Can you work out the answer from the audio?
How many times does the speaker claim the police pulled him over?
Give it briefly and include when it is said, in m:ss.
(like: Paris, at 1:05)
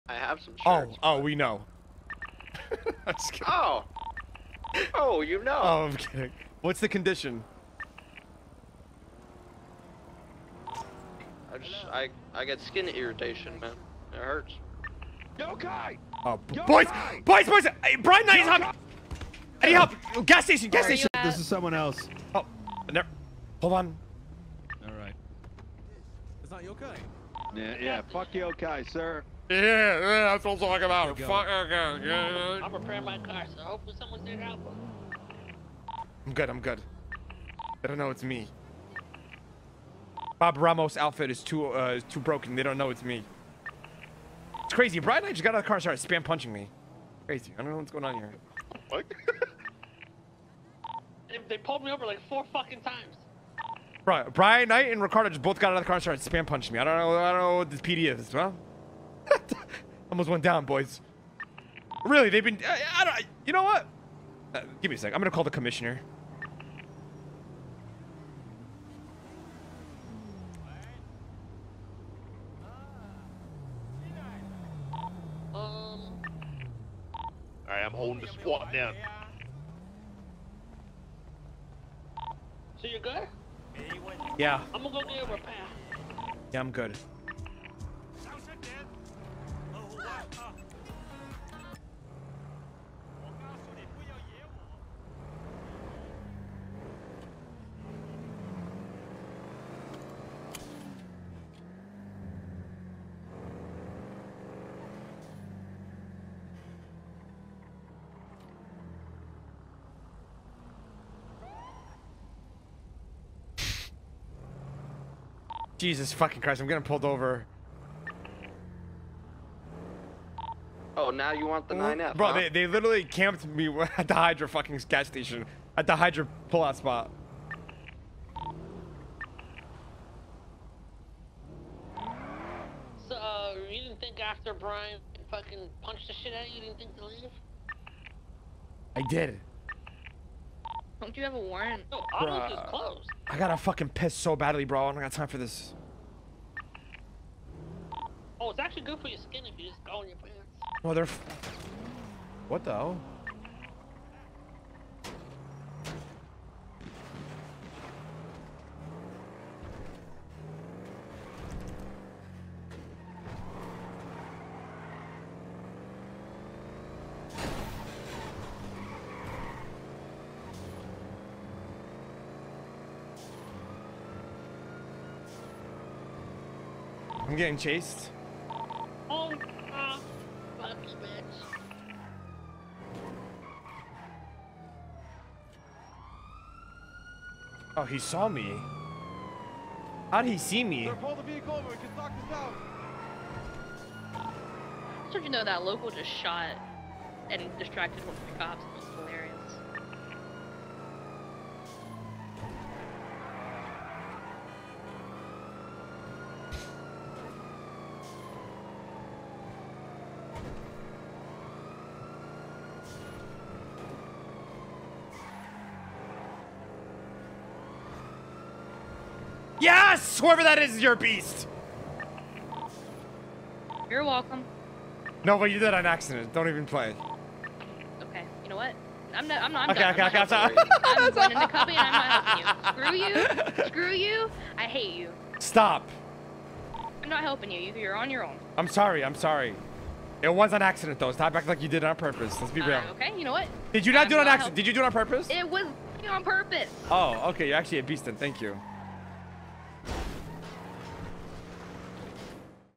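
4, at 0:52.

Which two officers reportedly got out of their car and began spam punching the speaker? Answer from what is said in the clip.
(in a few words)
Brian Knight and Ricardo.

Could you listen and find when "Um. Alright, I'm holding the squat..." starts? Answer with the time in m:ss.
1:15.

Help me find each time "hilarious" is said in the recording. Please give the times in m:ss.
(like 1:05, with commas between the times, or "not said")
3:18.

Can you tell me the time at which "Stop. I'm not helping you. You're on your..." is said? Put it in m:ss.
3:55.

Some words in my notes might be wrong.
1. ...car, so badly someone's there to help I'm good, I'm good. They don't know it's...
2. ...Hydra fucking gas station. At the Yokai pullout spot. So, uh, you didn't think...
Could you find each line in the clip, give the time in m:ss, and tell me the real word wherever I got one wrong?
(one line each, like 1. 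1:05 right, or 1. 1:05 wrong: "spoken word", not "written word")
1. 0:33 wrong: "hopefully", not "badly"
2. 2:04 wrong: "Hydra", not "Yokai".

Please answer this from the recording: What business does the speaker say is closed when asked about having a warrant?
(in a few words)
Autos.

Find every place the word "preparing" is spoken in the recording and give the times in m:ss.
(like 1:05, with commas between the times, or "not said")
0:32.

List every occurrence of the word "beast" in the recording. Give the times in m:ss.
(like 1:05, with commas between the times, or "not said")
3:40, 4:07.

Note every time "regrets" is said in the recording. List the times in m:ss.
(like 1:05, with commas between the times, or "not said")
not said.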